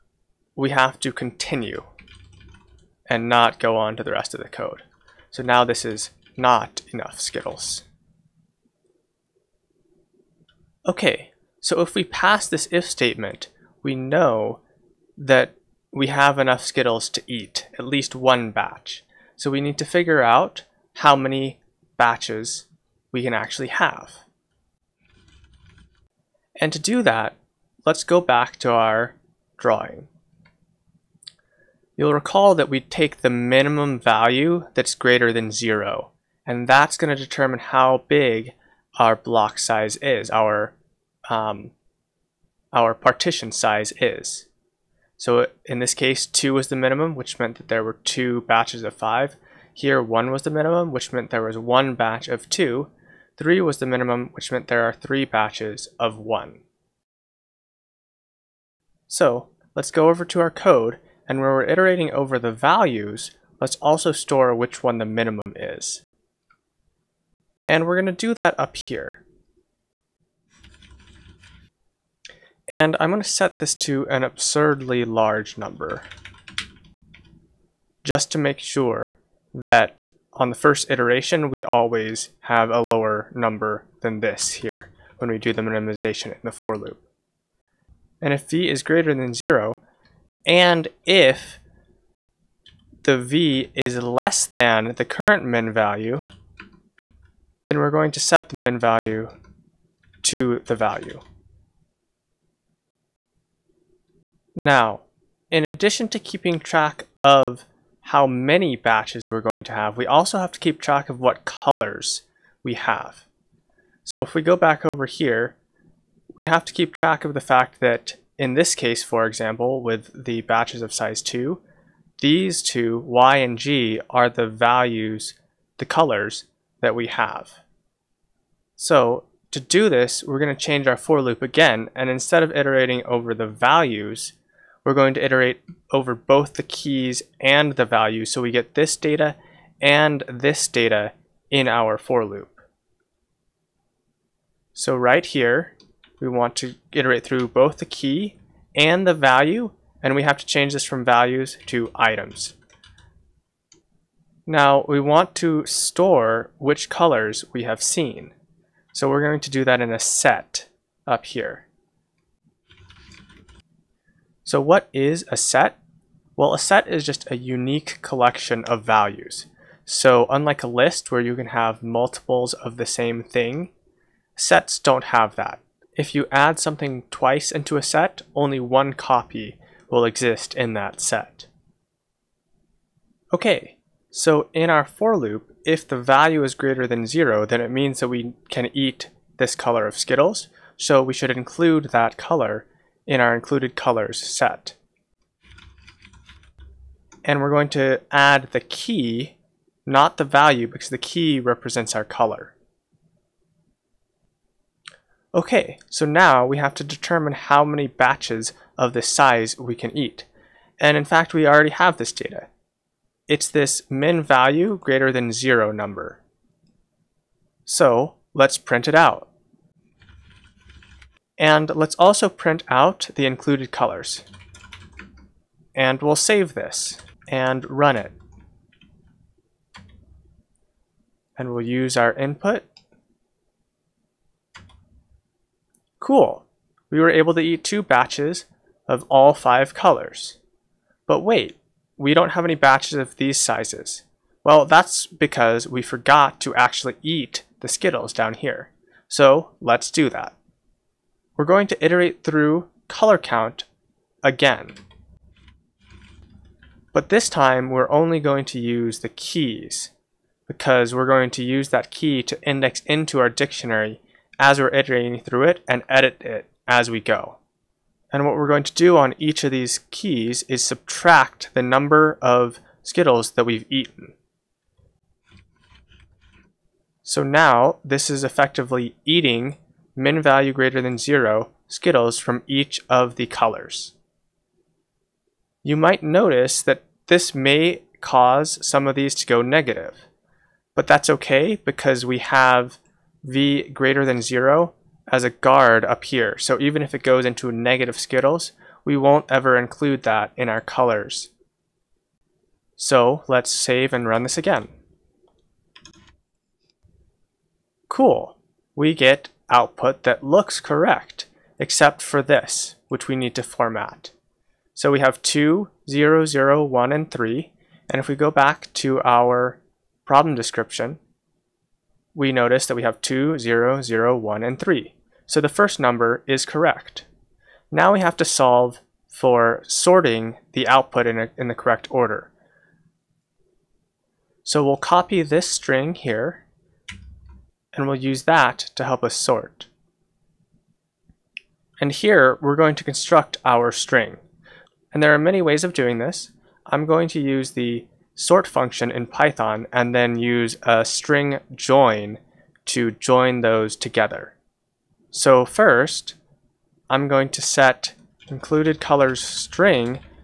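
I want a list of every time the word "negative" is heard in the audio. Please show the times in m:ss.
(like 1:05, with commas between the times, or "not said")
4:49, 4:57.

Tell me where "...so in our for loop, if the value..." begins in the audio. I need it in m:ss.
3:04.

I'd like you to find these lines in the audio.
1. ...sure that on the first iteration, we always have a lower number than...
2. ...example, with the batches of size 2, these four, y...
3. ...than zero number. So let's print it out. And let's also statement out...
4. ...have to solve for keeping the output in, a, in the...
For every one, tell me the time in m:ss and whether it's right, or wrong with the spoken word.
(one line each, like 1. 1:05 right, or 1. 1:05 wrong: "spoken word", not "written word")
1. 1:18 right
2. 1:59 wrong: "two", not "four"
3. 3:35 wrong: "print", not "statement"
4. 5:27 wrong: "sorting", not "keeping".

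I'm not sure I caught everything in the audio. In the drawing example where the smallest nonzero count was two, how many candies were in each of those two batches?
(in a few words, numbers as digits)
5.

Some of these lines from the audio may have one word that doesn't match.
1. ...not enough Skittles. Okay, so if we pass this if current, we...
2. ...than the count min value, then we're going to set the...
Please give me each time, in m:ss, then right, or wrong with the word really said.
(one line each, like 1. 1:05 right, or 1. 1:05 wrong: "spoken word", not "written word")
1. 0:06 wrong: "statement", not "current"
2. 1:34 wrong: "current", not "count".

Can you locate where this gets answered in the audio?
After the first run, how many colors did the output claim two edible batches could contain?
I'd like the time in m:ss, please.
3:59.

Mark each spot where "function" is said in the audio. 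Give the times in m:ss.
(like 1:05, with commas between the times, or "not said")
5:48.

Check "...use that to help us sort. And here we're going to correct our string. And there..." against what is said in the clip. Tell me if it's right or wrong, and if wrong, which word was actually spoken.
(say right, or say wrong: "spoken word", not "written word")
wrong: "construct", not "correct".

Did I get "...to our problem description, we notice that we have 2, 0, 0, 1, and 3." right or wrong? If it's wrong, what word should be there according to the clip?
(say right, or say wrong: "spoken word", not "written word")
right.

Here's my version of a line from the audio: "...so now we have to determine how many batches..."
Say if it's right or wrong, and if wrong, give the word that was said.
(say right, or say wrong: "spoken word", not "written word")
right.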